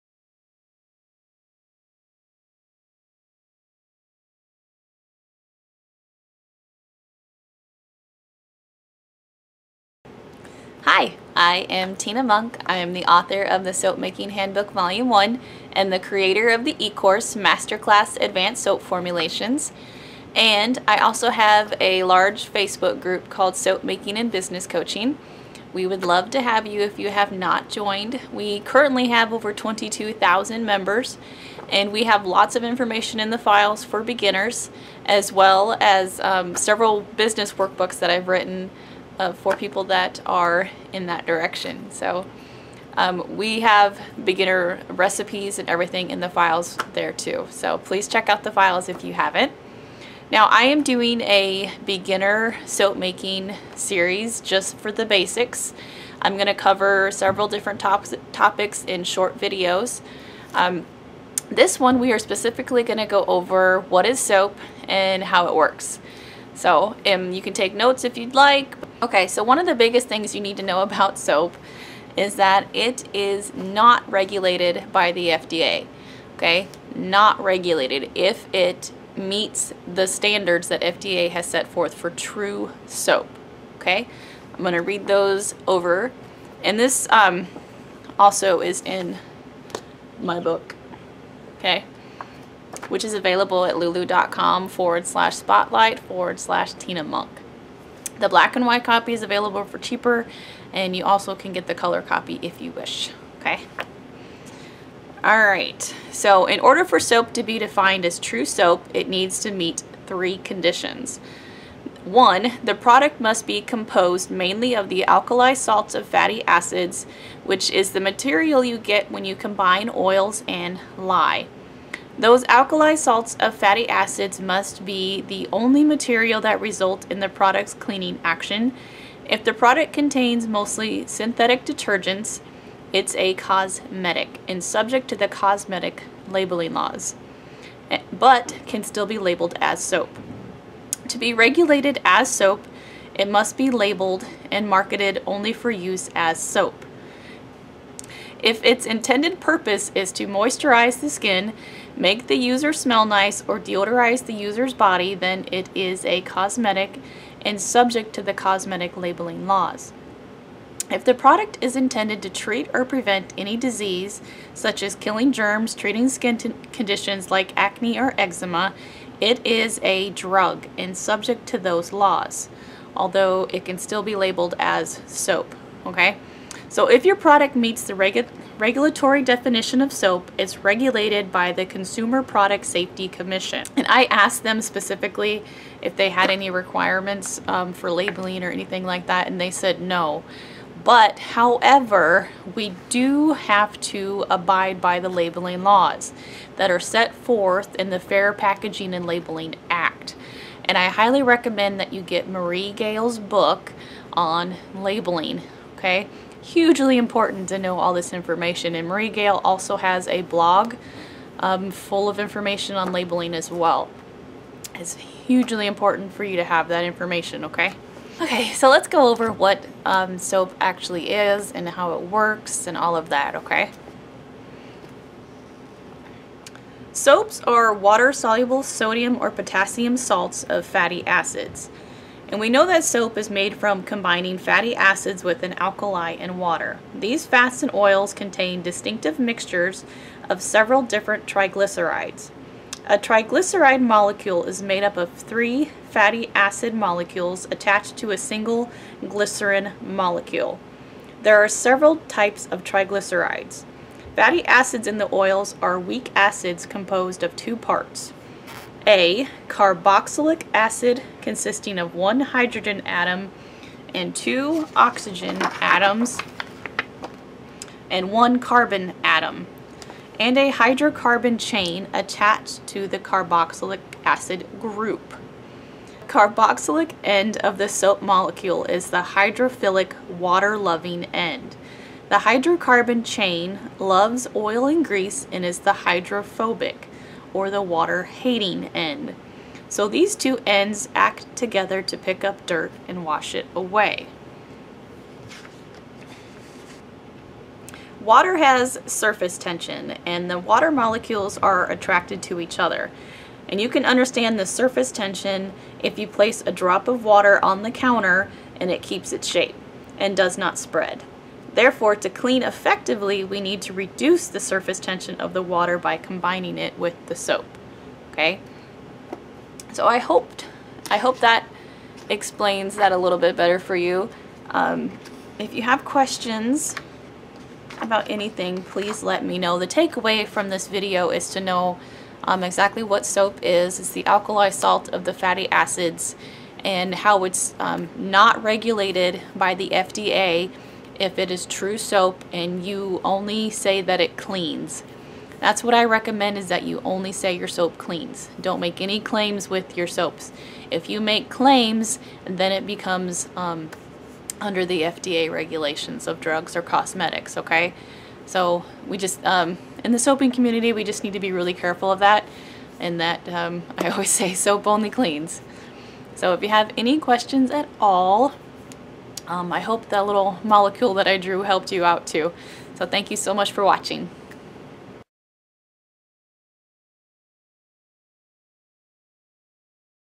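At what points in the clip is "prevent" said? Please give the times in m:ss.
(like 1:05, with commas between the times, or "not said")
2:42.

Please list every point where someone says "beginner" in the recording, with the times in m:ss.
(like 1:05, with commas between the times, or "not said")
0:34, 0:44, 0:51.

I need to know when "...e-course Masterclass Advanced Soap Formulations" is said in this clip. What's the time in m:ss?
0:16.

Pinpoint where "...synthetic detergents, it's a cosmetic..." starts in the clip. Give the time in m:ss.
2:11.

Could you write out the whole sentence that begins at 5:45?
That's what I recommend is that you only say your soap cleans.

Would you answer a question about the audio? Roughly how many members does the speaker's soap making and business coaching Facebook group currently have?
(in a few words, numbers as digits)
22,000.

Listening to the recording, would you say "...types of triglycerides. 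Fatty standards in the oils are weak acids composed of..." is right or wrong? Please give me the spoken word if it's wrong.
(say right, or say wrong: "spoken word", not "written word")
wrong: "acids", not "standards".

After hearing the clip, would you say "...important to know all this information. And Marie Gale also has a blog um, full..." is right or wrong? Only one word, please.
right.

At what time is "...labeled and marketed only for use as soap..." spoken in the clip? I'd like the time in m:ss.
2:23.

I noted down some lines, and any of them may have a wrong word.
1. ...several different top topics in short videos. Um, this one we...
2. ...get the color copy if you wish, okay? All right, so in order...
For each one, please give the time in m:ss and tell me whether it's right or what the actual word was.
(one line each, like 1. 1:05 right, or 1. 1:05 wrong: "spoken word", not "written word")
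1. 0:57 right
2. 1:41 right.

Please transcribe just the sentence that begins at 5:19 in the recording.
So I hoped, I hope that explains that a little bit better for you.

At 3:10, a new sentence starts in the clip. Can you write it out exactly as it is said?
But however, we do have to abide by the labeling laws that are set forth in the Fair Packaging and Labeling Act.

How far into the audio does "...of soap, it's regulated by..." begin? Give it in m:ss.
2:59.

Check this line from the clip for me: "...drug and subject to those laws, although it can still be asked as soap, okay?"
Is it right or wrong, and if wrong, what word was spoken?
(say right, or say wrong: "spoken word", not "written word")
wrong: "labeled", not "asked".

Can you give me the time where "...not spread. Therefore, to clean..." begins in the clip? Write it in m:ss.
5:10.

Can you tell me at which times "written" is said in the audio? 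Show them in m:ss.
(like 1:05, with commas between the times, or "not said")
0:38.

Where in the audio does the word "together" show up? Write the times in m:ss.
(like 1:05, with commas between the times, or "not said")
4:51.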